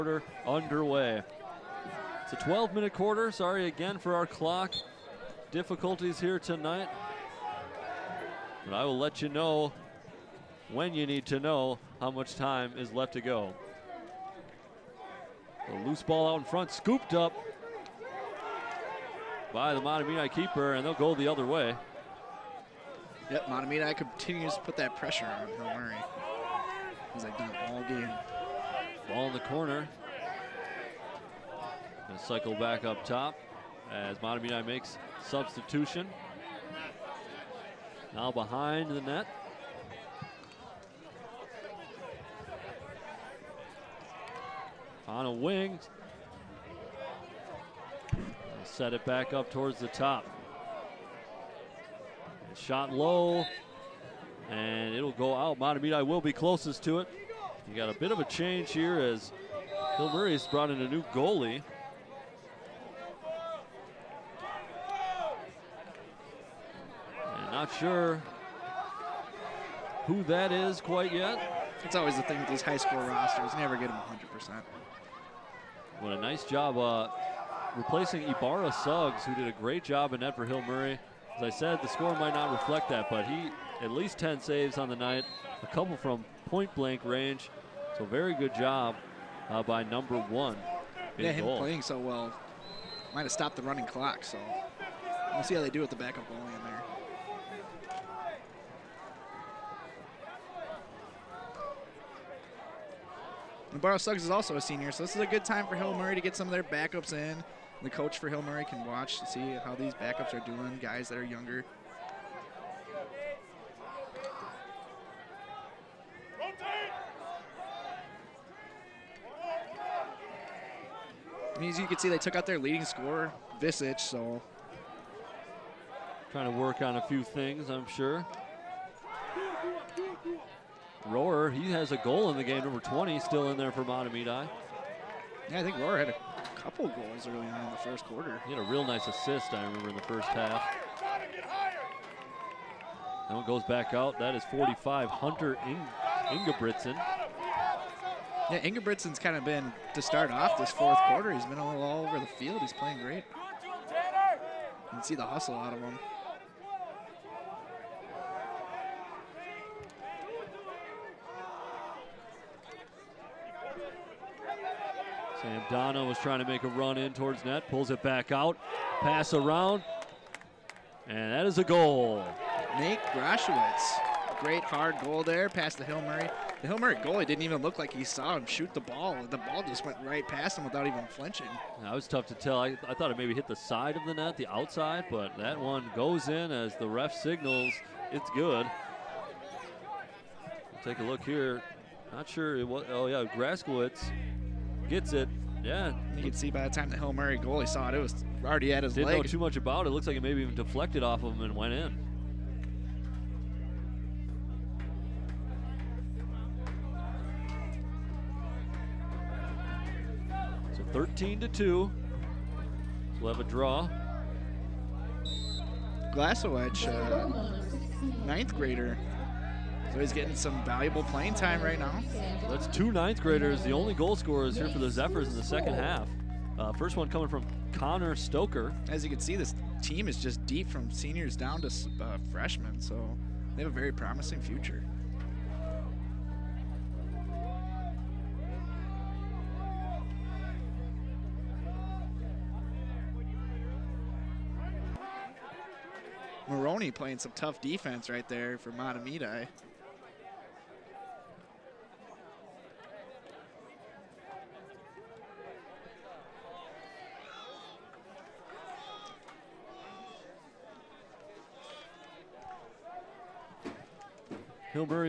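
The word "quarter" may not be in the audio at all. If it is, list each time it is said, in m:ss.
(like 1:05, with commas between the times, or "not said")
0:02, 2:18, 2:31.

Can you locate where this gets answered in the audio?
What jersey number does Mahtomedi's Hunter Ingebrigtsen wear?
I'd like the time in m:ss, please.
2:24.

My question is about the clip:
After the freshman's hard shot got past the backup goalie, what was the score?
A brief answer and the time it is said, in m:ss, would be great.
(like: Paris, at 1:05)
13 to 2, at 3:30.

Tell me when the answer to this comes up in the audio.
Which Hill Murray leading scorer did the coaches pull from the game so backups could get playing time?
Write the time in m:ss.
2:03.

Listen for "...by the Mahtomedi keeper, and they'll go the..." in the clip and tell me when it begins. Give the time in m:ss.
0:19.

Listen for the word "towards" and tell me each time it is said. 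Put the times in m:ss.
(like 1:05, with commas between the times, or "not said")
0:49, 2:47.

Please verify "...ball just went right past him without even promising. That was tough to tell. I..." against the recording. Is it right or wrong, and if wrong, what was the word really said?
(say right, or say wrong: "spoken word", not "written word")
wrong: "flinching", not "promising".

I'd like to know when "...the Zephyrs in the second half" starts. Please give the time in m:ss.
3:44.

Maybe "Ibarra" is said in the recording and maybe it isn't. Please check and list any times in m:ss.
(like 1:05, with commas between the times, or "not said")
1:18, 1:43.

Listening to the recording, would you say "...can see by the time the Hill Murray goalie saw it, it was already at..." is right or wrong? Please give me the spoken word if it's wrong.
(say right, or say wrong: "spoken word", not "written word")
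right.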